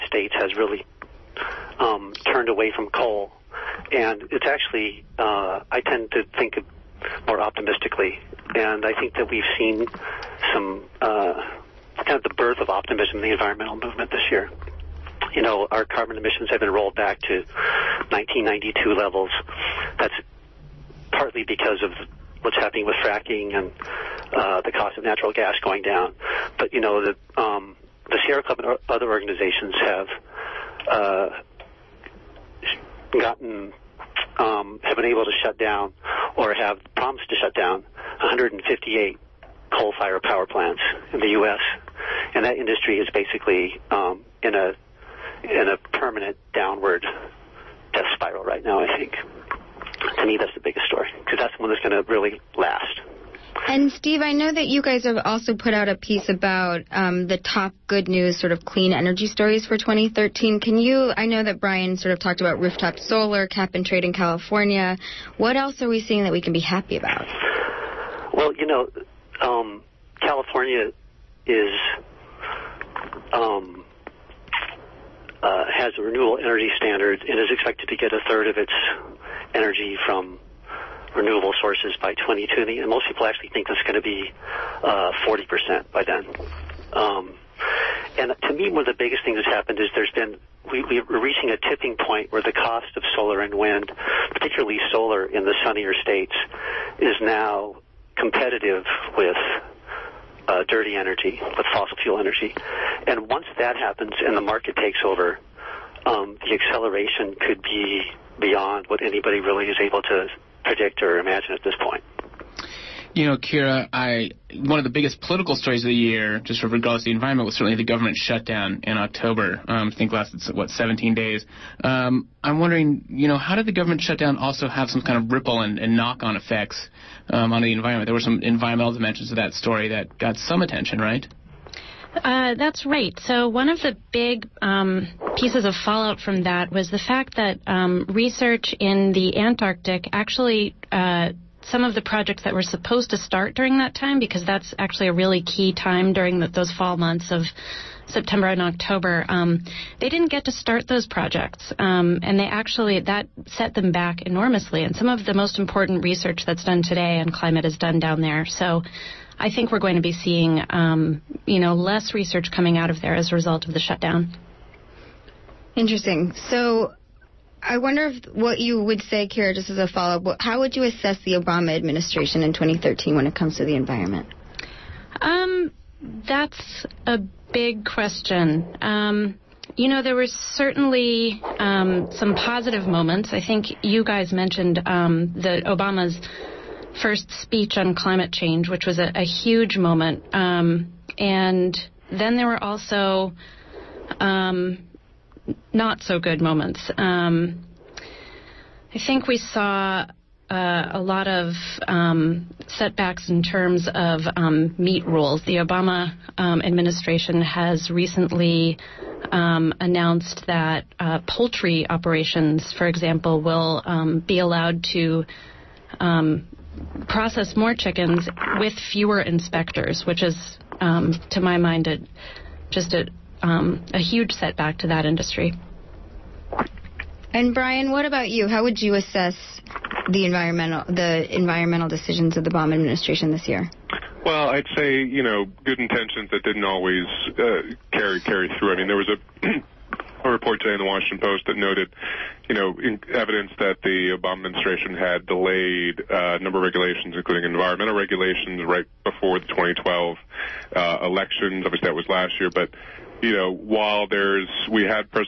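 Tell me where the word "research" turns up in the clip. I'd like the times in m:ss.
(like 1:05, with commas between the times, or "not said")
2:18, 2:36, 2:42.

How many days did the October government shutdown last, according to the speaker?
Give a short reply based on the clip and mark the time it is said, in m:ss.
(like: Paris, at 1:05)
17, at 2:00.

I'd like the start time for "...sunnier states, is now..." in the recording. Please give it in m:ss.
1:35.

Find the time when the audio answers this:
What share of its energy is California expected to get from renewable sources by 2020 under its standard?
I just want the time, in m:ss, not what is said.
1:18.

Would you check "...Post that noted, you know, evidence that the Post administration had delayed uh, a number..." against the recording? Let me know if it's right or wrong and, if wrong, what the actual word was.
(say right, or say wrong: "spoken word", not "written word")
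wrong: "Obama", not "Post".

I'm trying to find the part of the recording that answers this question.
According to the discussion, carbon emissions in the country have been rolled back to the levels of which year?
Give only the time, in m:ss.
0:18.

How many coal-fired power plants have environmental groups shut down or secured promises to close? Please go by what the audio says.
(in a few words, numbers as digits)
158.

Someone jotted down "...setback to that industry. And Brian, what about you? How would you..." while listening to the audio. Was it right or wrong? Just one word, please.
right.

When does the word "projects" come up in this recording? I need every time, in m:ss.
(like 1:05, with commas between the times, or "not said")
2:22, 2:31.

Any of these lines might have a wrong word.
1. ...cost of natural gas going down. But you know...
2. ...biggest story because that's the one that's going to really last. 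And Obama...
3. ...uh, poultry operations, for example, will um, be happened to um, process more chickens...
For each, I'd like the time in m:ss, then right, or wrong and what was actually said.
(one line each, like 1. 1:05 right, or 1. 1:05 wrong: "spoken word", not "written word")
1. 0:24 right
2. 0:50 wrong: "Steve", not "Obama"
3. 3:30 wrong: "allowed", not "happened".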